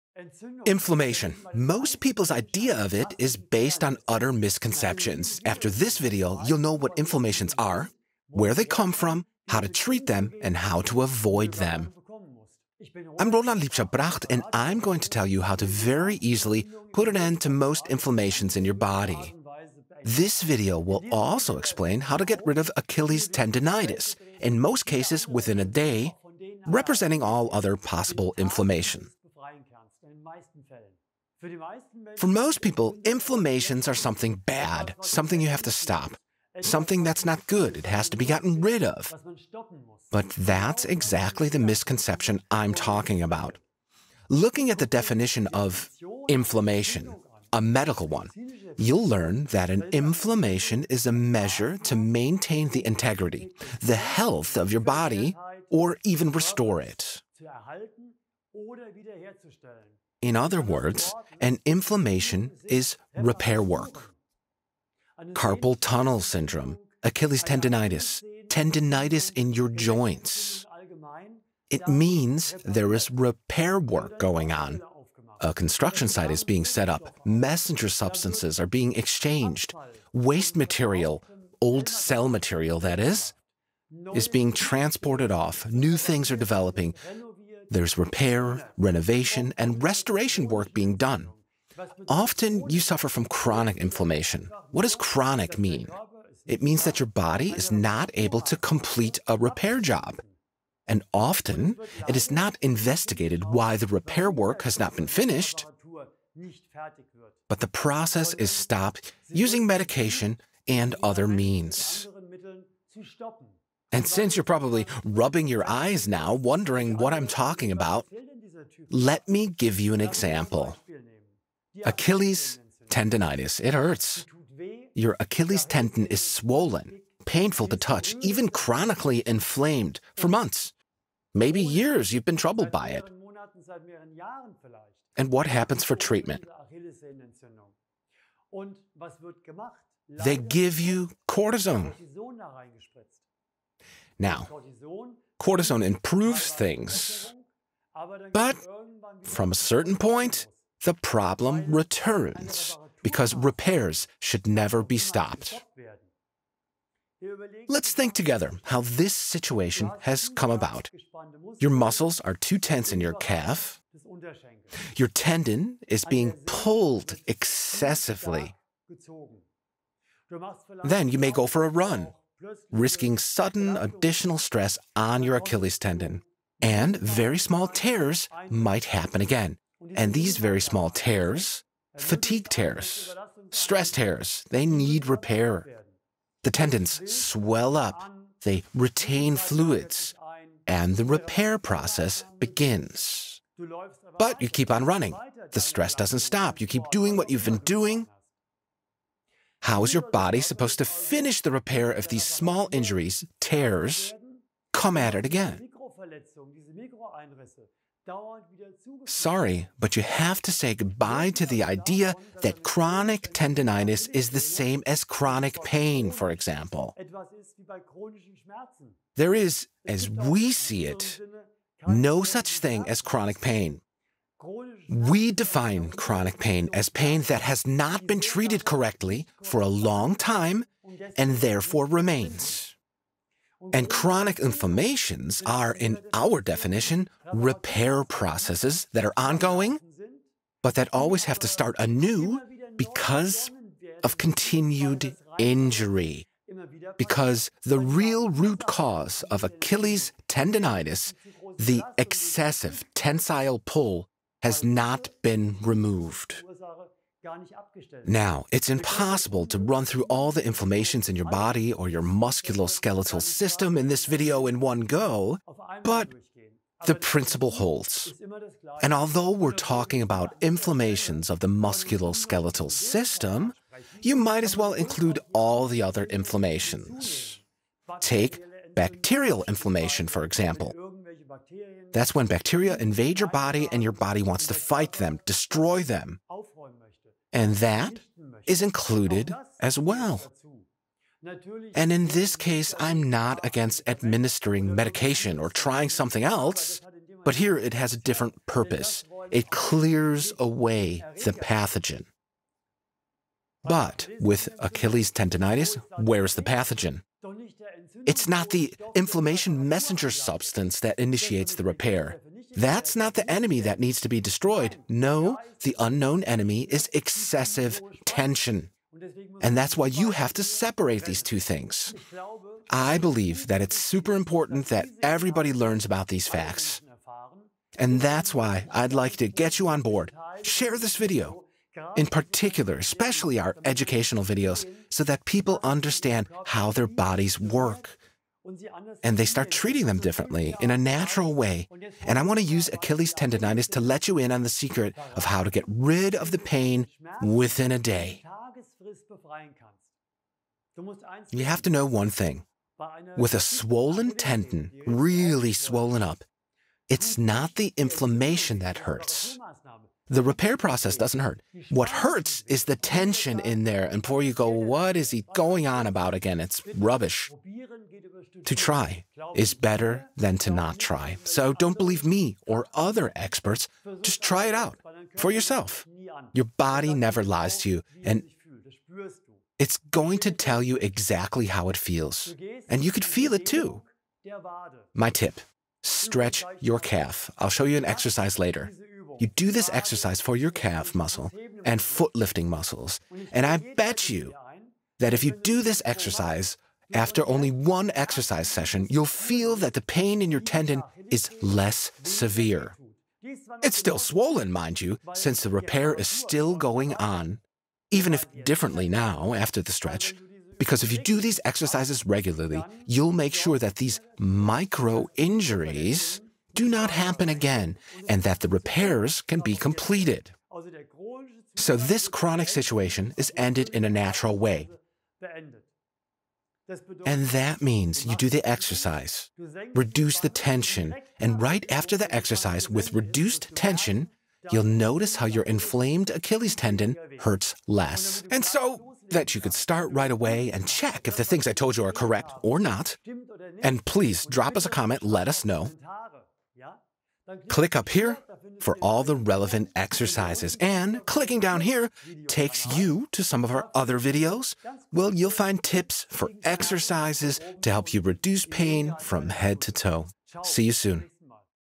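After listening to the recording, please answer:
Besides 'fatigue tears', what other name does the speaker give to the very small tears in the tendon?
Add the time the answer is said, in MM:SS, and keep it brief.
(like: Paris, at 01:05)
stress tears, at 03:03.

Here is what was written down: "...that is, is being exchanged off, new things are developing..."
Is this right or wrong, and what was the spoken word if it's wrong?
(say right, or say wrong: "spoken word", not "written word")
wrong: "transported", not "exchanged".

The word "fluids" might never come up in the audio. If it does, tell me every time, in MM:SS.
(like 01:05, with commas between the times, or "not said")
03:09.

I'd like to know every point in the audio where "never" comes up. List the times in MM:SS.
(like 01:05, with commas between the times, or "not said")
02:34, 06:16.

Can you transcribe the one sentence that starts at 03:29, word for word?
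Sorry, but you have to say goodbye to the idea that chronic tendinitis is the same as chronic pain, for example.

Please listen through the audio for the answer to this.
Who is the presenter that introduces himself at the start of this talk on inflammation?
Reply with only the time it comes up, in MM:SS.
00:13.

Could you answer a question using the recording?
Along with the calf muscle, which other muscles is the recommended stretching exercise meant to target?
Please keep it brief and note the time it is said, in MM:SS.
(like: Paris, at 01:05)
foot lifting muscles, at 06:31.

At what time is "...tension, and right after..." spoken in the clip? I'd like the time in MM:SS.
07:10.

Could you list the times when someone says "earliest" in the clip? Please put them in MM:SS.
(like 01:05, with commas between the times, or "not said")
not said.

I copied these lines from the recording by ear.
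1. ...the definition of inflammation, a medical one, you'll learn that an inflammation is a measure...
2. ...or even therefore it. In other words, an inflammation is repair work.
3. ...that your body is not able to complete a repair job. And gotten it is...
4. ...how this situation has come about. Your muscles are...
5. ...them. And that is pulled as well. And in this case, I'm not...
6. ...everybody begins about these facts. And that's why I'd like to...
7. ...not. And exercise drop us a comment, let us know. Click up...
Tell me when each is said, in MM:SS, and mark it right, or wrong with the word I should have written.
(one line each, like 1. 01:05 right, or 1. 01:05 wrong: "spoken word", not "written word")
1. 00:44 right
2. 00:55 wrong: "restore", not "therefore"
3. 01:36 wrong: "often", not "gotten"
4. 02:38 right
5. 04:45 wrong: "included", not "pulled"
6. 05:25 wrong: "learns", not "begins"
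7. 07:22 wrong: "please", not "exercise".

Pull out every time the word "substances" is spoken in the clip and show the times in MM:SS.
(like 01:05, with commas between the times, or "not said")
01:17, 05:10.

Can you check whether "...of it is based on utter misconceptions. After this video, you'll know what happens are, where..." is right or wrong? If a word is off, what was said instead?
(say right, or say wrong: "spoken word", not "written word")
wrong: "inflammations", not "happens".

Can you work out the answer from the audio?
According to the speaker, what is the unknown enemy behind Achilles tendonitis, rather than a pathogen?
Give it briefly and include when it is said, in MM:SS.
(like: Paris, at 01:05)
excessive tension, at 05:16.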